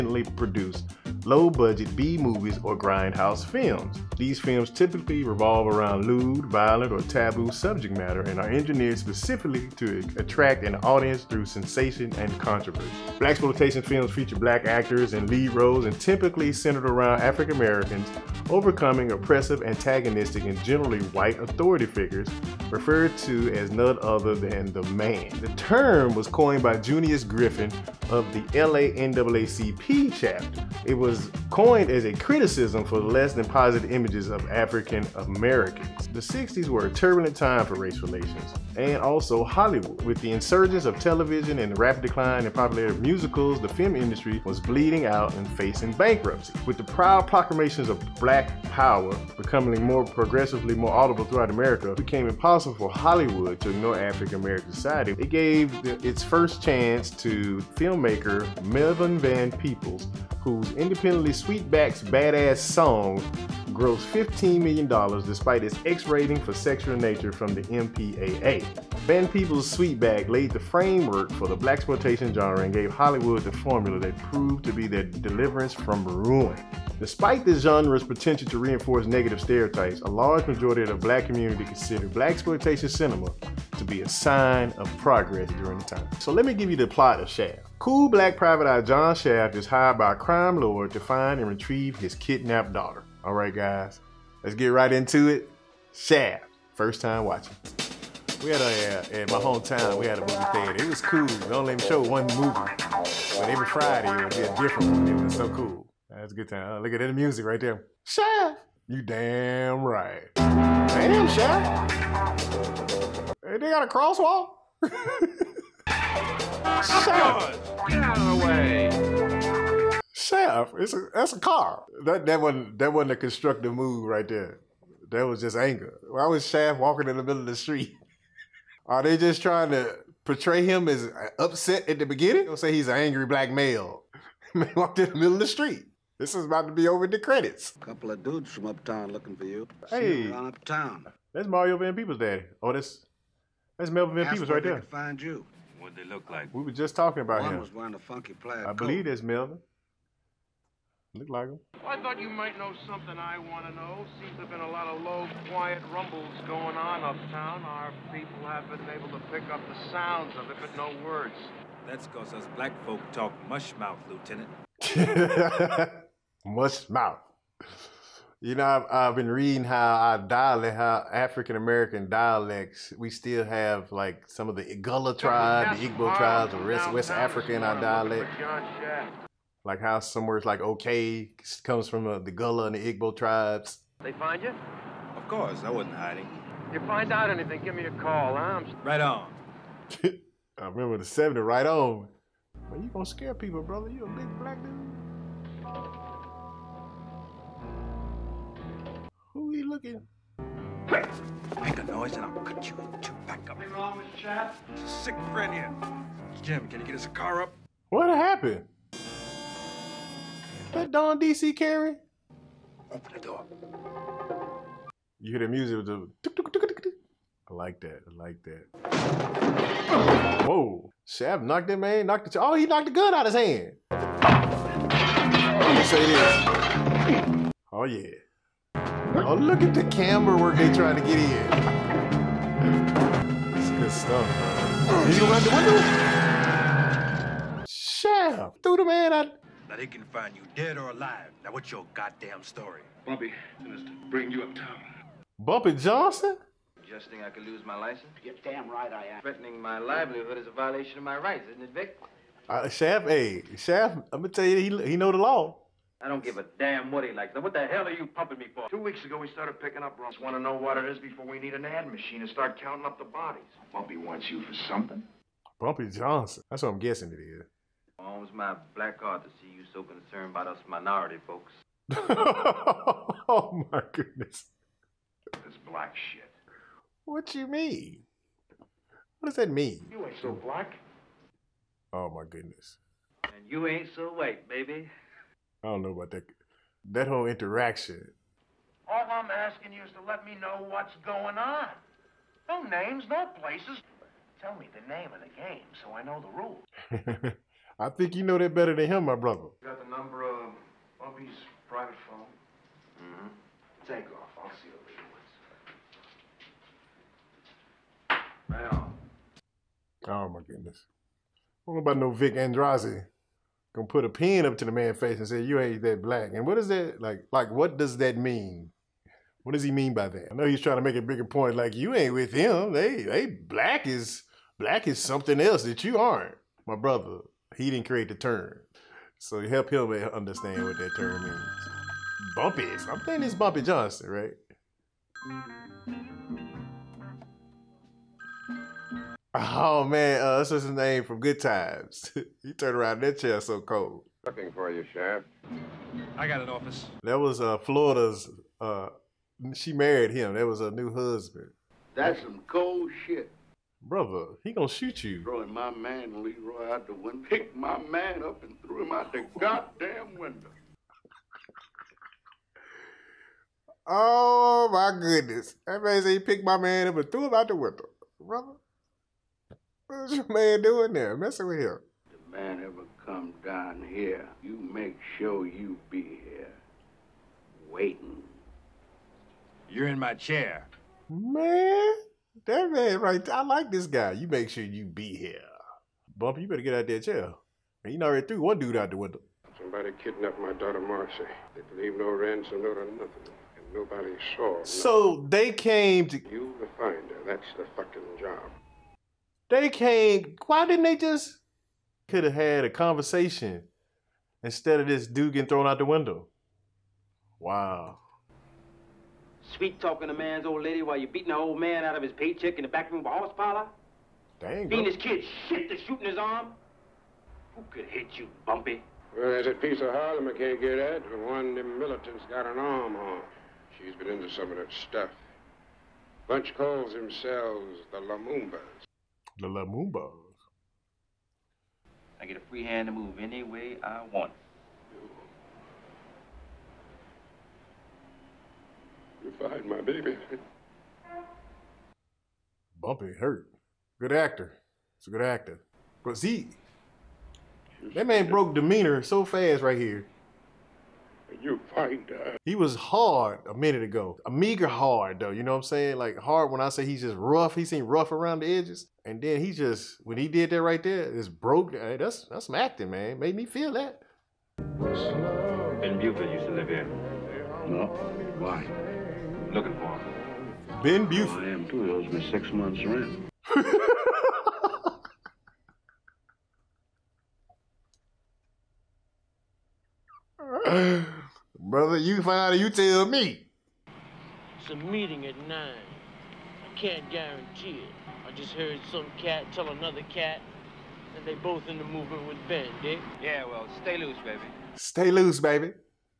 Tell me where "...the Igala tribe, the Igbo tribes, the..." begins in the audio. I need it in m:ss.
2:54.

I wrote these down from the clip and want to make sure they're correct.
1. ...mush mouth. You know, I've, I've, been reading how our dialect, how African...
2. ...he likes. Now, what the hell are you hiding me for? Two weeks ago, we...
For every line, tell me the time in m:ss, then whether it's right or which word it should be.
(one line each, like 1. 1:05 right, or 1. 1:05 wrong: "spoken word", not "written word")
1. 2:46 right
2. 4:17 wrong: "pumping", not "hiding".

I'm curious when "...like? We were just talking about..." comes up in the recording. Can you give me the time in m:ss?
2:26.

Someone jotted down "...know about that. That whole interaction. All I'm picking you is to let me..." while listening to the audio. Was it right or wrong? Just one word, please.
wrong.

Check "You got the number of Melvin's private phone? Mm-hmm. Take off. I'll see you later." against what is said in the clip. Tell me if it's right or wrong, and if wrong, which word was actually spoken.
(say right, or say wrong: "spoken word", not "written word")
wrong: "Bubby", not "Melvin".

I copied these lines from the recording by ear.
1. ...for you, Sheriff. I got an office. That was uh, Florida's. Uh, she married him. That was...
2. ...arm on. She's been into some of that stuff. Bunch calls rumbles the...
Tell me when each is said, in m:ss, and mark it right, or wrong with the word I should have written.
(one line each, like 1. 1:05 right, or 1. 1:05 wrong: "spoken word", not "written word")
1. 5:44 right
2. 7:02 wrong: "themselves", not "rumbles".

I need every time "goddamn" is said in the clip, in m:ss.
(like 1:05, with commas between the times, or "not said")
4:01, 5:59.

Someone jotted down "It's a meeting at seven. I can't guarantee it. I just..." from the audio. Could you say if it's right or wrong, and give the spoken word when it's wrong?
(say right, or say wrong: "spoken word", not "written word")
wrong: "nine", not "seven".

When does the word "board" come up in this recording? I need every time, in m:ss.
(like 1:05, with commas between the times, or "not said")
not said.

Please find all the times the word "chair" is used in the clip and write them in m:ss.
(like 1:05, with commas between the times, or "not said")
5:43, 6:20, 6:27.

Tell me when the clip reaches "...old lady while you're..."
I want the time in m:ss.
6:50.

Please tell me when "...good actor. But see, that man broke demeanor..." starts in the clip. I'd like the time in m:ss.
7:25.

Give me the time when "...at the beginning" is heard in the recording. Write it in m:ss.
2:11.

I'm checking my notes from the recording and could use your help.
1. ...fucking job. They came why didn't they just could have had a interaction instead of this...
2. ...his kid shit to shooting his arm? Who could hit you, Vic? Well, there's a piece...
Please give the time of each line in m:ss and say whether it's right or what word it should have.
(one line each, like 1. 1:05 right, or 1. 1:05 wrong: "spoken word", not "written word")
1. 6:37 wrong: "conversation", not "interaction"
2. 6:54 wrong: "Bumpy", not "Vic".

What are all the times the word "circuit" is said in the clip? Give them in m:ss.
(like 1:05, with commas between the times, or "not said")
not said.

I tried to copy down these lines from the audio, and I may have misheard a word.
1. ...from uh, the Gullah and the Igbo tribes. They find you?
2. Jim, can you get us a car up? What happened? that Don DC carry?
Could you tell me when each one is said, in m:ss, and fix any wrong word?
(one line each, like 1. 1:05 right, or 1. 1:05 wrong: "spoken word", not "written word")
1. 3:01 right
2. 3:26 right.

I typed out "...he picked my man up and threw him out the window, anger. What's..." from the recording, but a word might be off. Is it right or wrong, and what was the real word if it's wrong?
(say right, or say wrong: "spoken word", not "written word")
wrong: "brother", not "anger".